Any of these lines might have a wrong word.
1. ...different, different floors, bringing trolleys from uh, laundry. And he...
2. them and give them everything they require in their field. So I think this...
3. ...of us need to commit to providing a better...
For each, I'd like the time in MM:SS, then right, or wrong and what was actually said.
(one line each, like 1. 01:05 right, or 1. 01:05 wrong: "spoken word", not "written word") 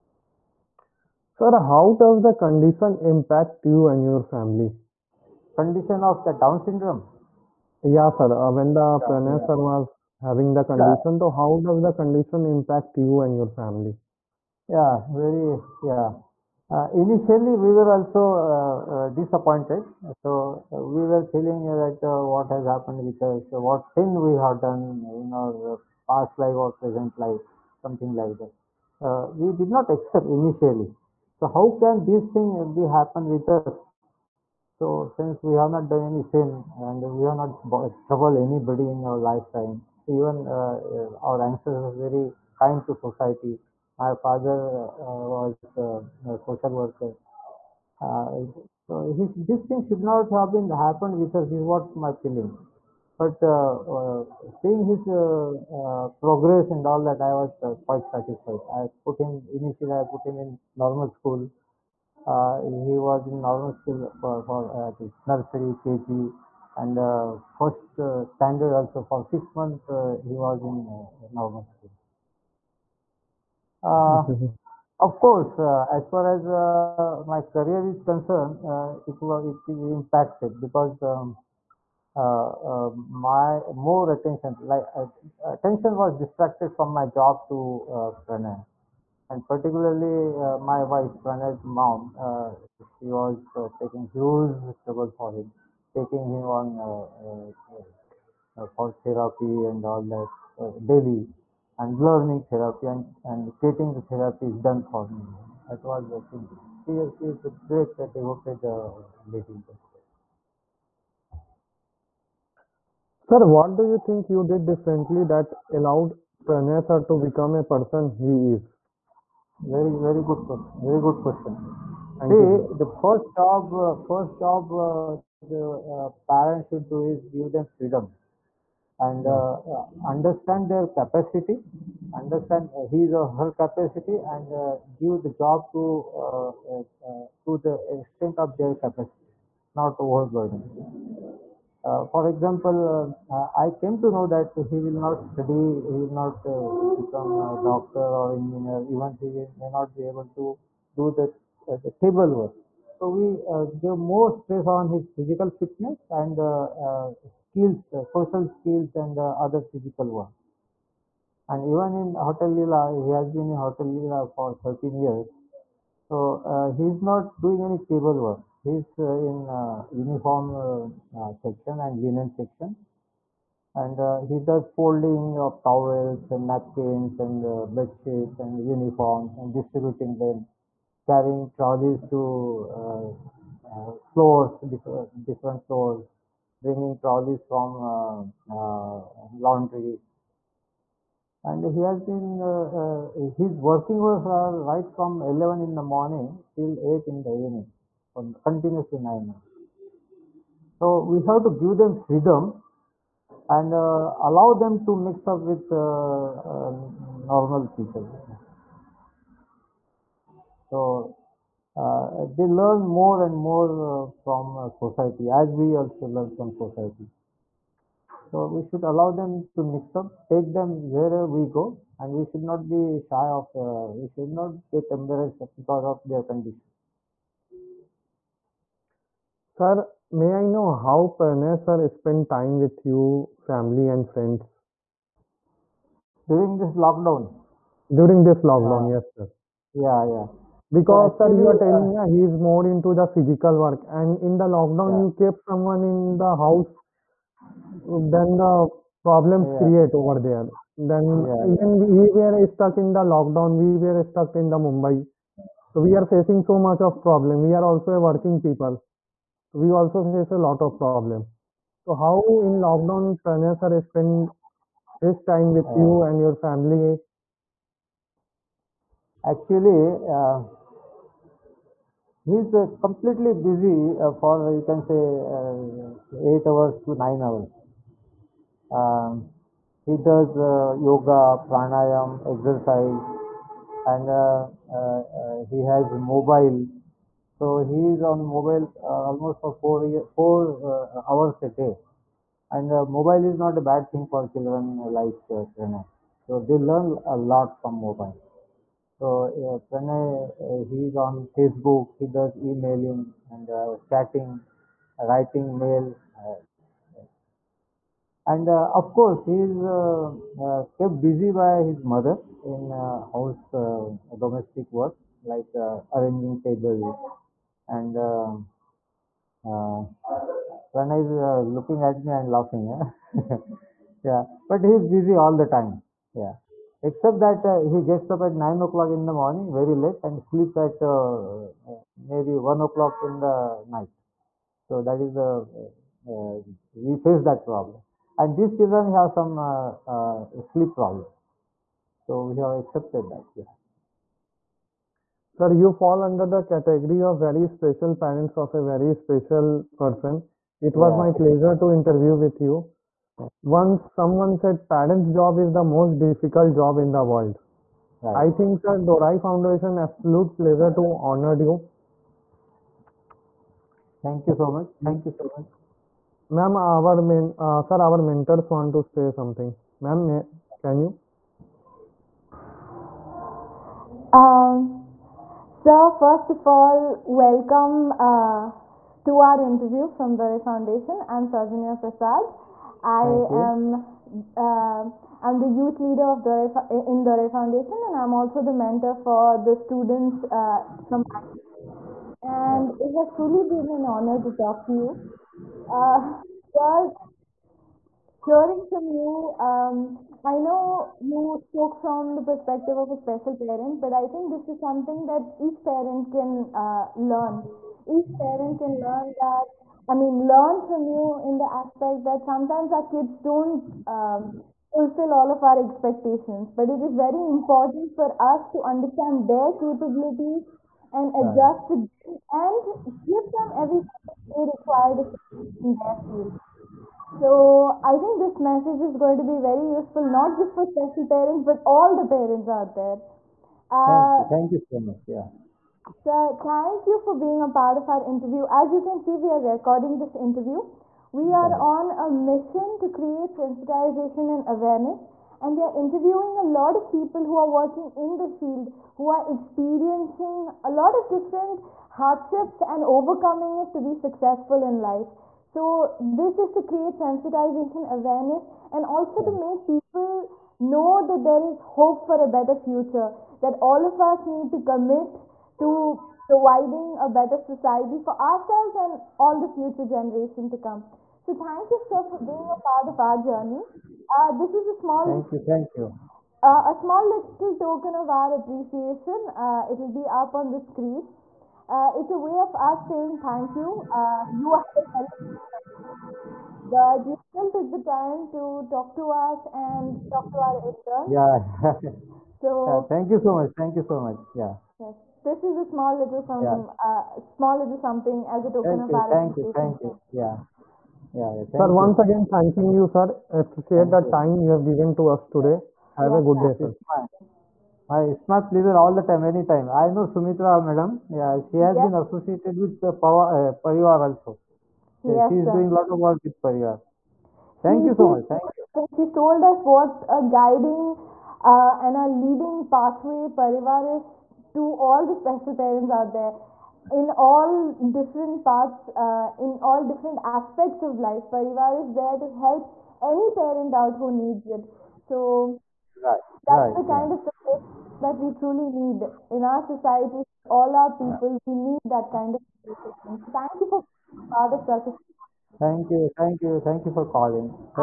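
1. 03:04 right
2. 07:01 right
3. 07:43 right.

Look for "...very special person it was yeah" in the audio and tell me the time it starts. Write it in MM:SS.
05:48.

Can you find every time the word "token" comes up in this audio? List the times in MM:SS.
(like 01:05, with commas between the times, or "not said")
07:57, 08:18.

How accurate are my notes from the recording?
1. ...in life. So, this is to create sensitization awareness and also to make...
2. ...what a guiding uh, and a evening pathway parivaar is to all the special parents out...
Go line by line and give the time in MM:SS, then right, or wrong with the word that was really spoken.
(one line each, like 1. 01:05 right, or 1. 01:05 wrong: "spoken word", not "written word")
1. 07:34 right
2. 08:39 wrong: "leading", not "evening".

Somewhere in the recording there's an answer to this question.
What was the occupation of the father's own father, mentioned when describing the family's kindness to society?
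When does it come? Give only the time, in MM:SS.
00:46.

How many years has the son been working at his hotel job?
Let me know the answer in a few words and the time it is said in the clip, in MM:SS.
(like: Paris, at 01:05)
13, at 02:44.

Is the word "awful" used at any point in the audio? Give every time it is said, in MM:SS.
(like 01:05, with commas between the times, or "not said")
not said.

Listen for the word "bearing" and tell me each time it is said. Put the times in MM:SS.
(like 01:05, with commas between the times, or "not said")
not said.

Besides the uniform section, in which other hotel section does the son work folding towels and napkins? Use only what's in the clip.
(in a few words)
Linen section.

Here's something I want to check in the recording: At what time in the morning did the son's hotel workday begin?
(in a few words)
11.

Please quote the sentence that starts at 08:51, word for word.
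Parivaar is there to help any parent out who needs it.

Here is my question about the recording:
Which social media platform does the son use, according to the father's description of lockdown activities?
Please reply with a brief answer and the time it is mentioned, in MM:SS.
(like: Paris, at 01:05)
Facebook, at 05:01.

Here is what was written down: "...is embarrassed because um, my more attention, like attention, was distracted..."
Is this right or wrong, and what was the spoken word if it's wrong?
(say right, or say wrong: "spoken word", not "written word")
wrong: "impacted", not "embarrassed".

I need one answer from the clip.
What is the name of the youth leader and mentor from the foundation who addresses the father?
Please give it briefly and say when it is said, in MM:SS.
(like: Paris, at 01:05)
Sarjanya Prasad, at 06:21.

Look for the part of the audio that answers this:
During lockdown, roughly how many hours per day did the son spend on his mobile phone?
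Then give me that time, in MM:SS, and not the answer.
04:50.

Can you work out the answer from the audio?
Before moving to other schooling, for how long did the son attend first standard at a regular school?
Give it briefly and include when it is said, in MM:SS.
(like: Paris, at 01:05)
6 months, at 01:09.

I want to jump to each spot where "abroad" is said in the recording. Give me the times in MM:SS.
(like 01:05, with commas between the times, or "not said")
not said.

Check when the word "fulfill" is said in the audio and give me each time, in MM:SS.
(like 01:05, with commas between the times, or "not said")
06:54.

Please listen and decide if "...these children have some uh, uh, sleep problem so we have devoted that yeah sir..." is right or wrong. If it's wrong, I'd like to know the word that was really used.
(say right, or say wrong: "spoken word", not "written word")
wrong: "accepted", not "devoted".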